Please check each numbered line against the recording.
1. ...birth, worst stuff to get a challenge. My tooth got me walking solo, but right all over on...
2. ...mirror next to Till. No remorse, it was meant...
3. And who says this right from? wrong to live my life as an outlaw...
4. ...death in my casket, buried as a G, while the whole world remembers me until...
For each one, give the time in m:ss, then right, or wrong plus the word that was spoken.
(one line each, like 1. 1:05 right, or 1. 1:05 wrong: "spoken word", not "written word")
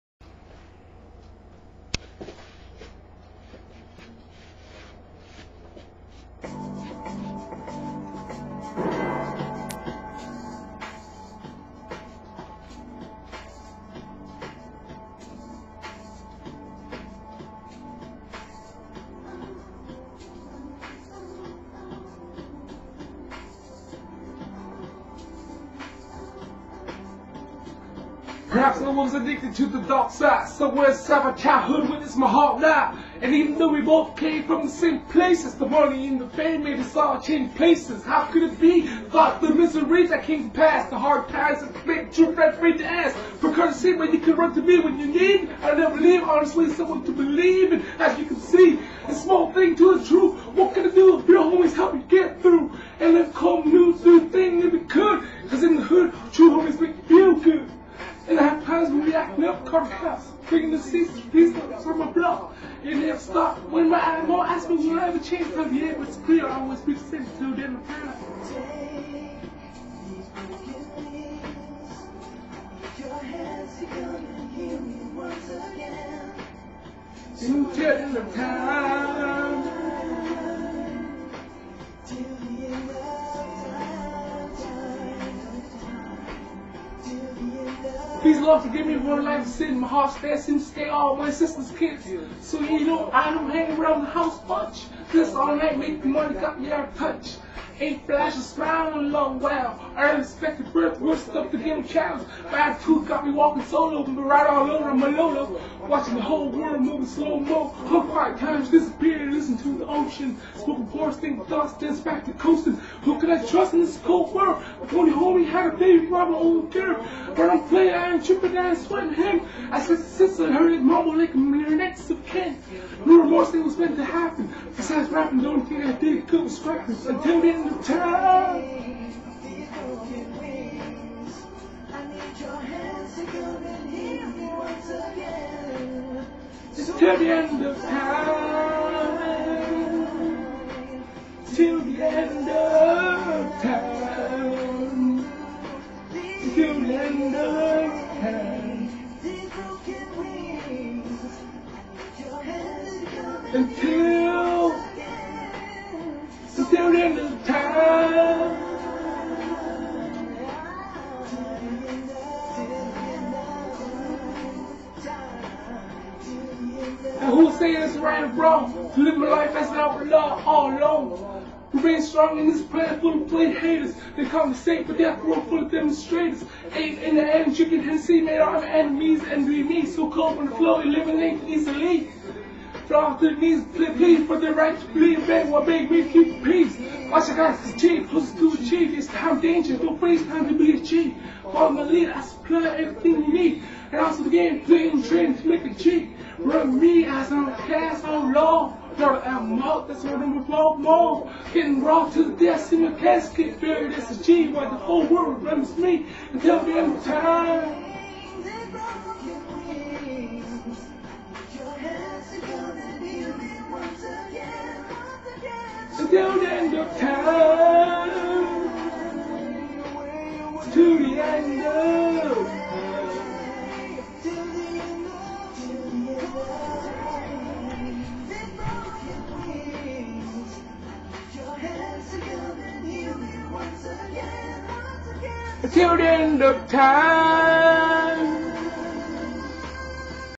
1. 1:40 right
2. 2:01 wrong: "Ken", not "Till"
3. 2:47 right
4. 3:22 right.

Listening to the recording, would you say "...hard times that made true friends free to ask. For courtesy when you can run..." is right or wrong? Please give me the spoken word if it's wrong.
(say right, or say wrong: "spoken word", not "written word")
right.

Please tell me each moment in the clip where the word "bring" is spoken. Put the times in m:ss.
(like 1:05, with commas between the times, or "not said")
1:00.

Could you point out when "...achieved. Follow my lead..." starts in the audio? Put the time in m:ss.
3:10.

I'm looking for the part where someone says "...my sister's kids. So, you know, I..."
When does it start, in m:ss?
1:31.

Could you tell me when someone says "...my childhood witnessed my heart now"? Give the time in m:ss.
0:31.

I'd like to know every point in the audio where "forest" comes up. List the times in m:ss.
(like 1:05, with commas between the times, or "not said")
1:50.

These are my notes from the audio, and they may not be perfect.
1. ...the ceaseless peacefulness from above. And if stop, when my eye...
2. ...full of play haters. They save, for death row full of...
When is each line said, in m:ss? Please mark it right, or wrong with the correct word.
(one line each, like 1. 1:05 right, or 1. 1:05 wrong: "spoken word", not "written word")
1. 1:00 right
2. 2:53 right.